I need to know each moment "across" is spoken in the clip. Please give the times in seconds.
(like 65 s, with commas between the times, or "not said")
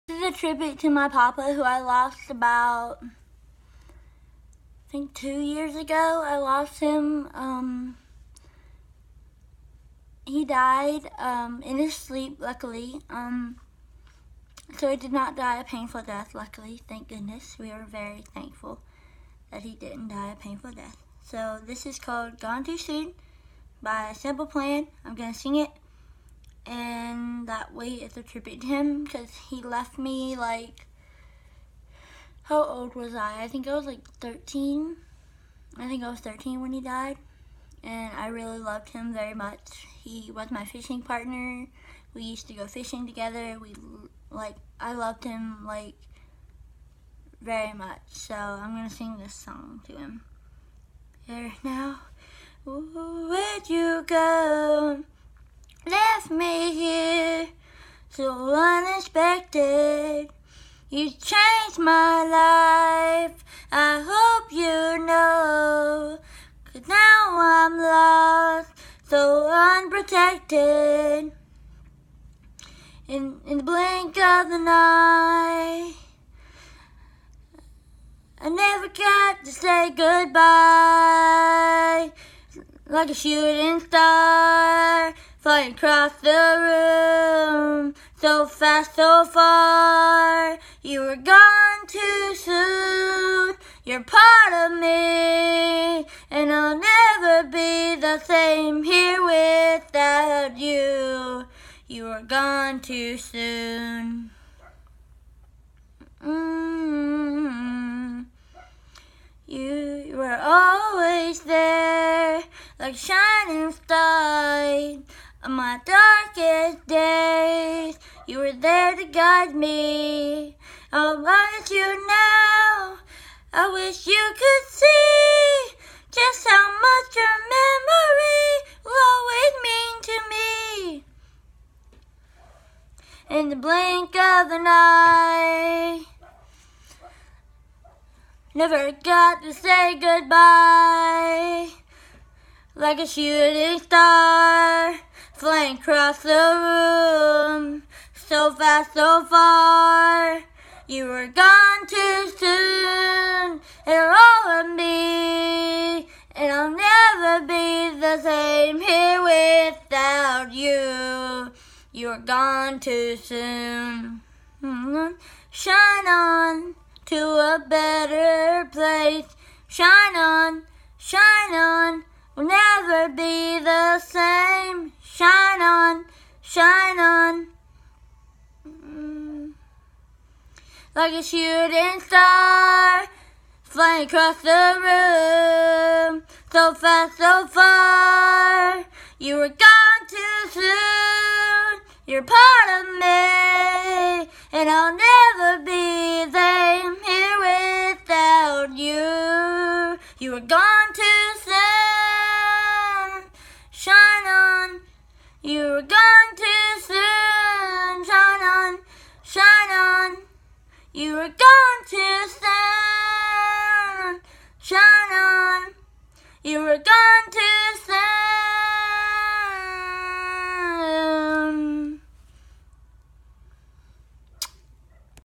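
85 s, 145 s, 184 s.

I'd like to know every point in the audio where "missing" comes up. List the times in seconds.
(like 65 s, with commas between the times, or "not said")
not said.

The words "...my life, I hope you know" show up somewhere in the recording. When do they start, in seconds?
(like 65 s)
61 s.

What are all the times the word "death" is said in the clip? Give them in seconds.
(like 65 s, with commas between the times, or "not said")
16 s, 20 s.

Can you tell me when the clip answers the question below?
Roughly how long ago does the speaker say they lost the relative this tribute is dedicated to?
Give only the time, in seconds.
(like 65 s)
5 s.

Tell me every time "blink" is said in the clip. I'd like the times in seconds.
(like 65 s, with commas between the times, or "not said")
73 s, 133 s.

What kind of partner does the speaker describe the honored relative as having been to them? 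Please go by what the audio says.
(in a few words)
Fishing partner.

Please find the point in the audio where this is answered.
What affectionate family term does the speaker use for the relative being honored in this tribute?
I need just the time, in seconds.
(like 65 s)
1 s.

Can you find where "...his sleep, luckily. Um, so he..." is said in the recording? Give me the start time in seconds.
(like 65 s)
11 s.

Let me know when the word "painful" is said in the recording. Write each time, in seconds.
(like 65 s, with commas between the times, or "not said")
15 s, 20 s.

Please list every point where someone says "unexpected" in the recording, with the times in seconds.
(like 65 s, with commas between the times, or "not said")
58 s.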